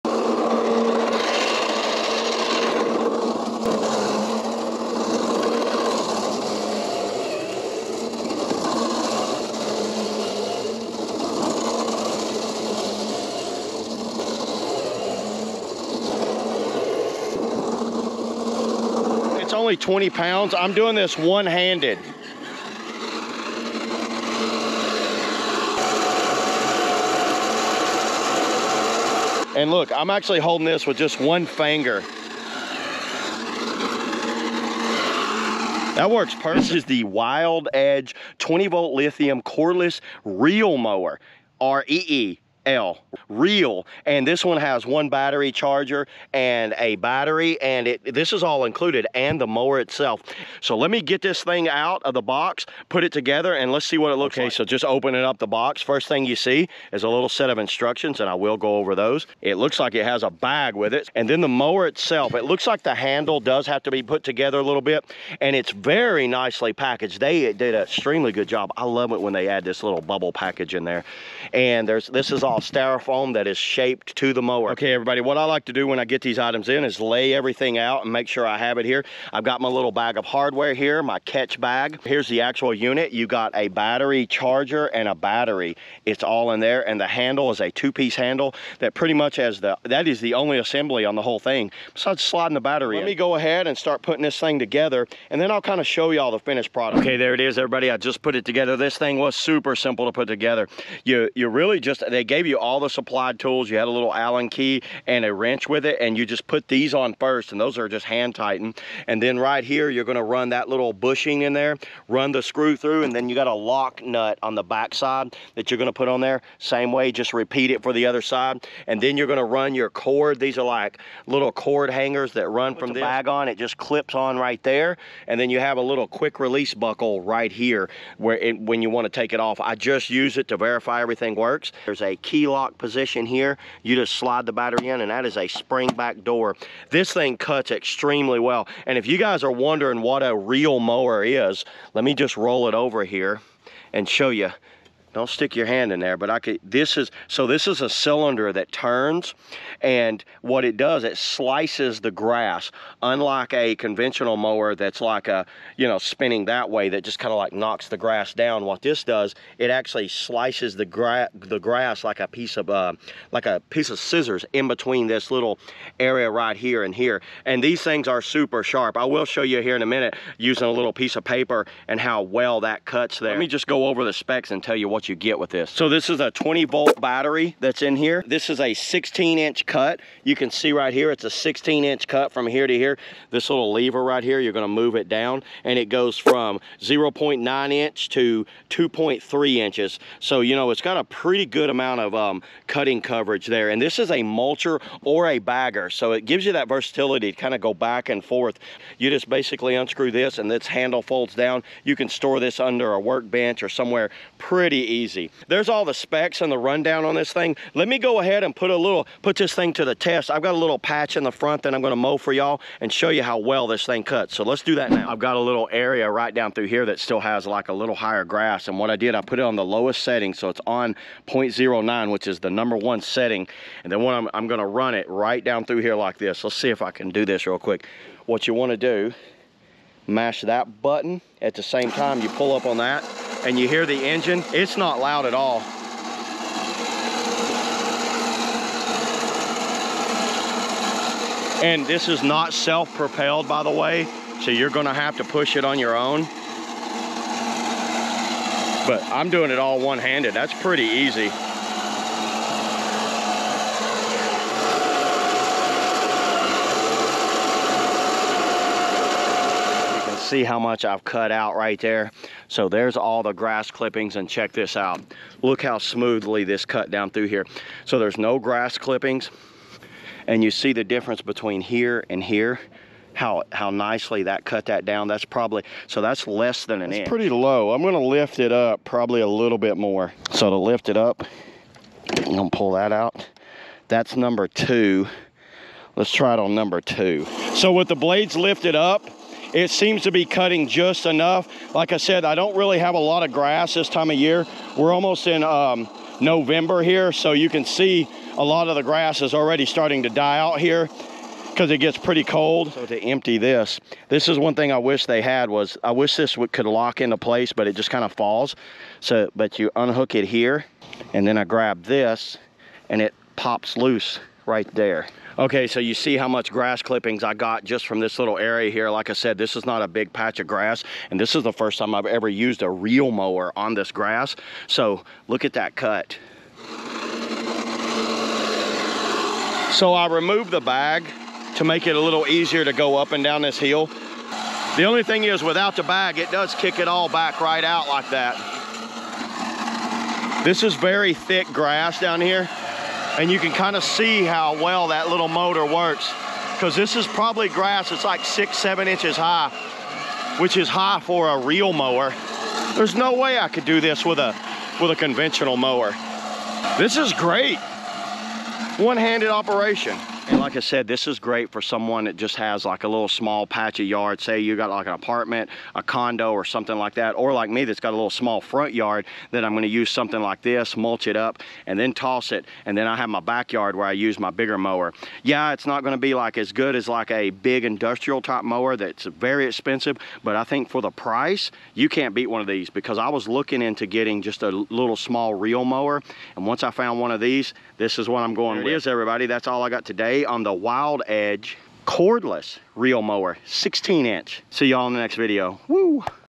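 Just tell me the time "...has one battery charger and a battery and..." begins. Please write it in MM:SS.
00:44.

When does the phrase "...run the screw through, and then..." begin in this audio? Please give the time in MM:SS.
01:52.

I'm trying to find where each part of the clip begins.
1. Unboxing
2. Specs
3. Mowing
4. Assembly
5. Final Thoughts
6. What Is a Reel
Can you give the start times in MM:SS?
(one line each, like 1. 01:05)
1. 00:37
2. 02:54
3. 03:35
4. 01:13
5. 05:59
6. 02:20.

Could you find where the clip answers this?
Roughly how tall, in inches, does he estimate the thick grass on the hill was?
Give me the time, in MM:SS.
05:48.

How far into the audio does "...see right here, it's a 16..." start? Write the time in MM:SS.
03:00.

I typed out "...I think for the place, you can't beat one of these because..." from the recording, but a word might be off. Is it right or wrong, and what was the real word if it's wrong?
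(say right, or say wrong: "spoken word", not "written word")
wrong: "price", not "place".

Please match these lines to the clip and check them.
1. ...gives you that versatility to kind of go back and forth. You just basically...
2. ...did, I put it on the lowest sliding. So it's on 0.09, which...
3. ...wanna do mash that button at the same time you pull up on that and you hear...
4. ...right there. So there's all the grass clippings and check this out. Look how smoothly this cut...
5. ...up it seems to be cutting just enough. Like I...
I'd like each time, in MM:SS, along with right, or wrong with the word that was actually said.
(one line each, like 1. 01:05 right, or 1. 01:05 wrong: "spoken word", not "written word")
1. 03:16 right
2. 03:38 wrong: "setting", not "sliding"
3. 03:48 right
4. 04:21 right
5. 04:48 right.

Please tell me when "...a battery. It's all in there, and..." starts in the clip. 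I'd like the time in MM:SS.
01:25.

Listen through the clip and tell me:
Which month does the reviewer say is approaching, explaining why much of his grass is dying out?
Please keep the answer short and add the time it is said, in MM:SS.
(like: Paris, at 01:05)
November, at 04:56.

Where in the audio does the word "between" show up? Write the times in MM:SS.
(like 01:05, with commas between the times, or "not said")
02:44, 04:31.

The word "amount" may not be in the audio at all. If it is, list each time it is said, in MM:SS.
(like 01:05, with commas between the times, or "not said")
03:11.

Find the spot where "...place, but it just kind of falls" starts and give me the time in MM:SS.
05:07.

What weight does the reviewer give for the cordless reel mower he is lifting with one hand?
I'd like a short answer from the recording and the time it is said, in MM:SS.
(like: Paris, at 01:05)
20 pounds, at 00:19.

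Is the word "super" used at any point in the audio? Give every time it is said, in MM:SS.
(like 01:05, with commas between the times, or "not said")
01:39, 02:48.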